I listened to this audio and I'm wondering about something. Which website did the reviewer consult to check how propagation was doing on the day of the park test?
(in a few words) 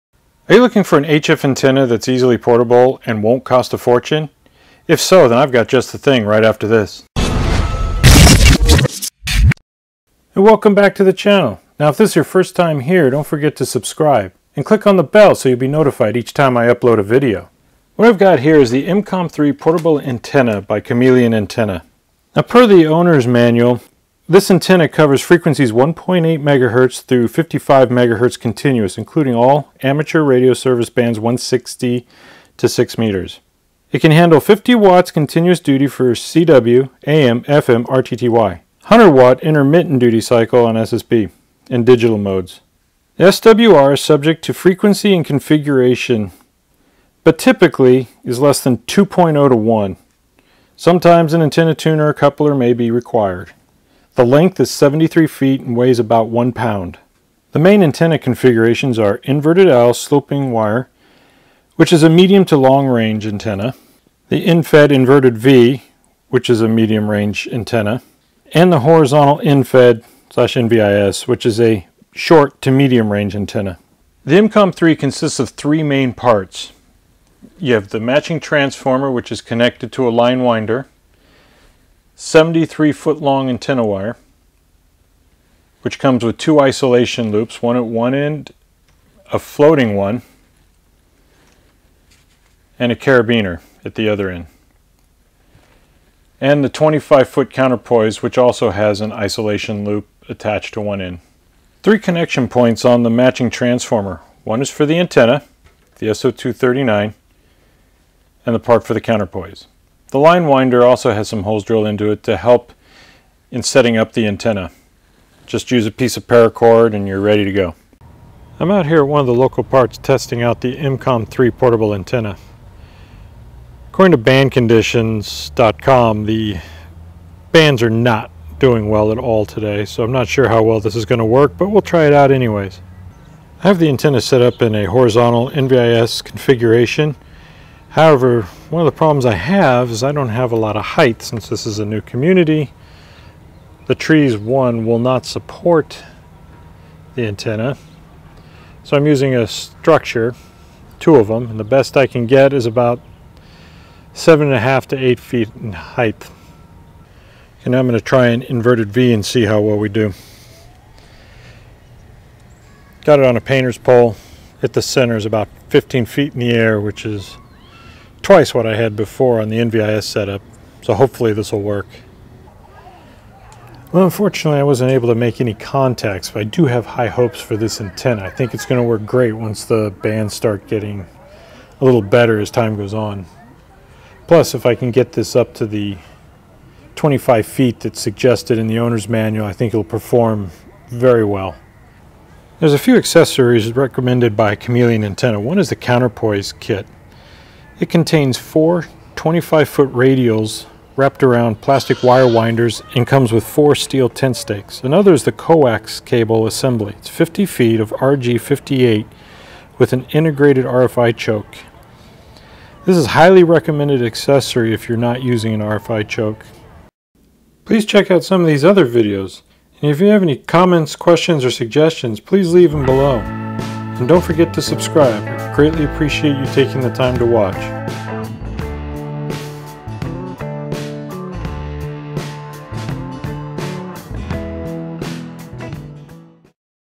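bandconditions.com.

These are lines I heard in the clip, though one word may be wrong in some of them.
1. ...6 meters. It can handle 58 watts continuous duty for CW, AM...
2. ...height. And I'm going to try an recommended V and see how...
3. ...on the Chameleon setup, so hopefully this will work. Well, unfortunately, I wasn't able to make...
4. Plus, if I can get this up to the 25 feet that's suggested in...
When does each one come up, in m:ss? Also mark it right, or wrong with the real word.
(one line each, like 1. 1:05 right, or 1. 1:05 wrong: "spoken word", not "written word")
1. 0:32 wrong: "50", not "58"
2. 2:35 wrong: "inverted", not "recommended"
3. 2:49 wrong: "NVIS", not "Chameleon"
4. 3:04 right.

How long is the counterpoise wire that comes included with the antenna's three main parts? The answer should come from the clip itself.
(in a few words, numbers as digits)
25 feet.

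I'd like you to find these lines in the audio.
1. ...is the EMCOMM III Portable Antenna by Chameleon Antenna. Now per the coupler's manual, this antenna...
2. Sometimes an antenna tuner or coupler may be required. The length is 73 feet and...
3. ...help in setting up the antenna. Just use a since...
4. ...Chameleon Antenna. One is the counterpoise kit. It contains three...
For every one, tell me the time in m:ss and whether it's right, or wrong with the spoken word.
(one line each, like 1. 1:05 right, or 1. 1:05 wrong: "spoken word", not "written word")
1. 0:18 wrong: "owner", not "coupler"
2. 0:50 right
3. 1:52 wrong: "piece", not "since"
4. 3:14 wrong: "four", not "three".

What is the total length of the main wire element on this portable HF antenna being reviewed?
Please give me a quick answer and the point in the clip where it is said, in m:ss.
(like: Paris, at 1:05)
73 feet, at 1:22.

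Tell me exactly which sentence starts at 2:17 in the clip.
However, one of the problems I have is I don't have a lot of height since this is a new community.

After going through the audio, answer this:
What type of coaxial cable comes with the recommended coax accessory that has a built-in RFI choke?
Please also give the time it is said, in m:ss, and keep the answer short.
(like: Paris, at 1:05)
RG58, at 3:27.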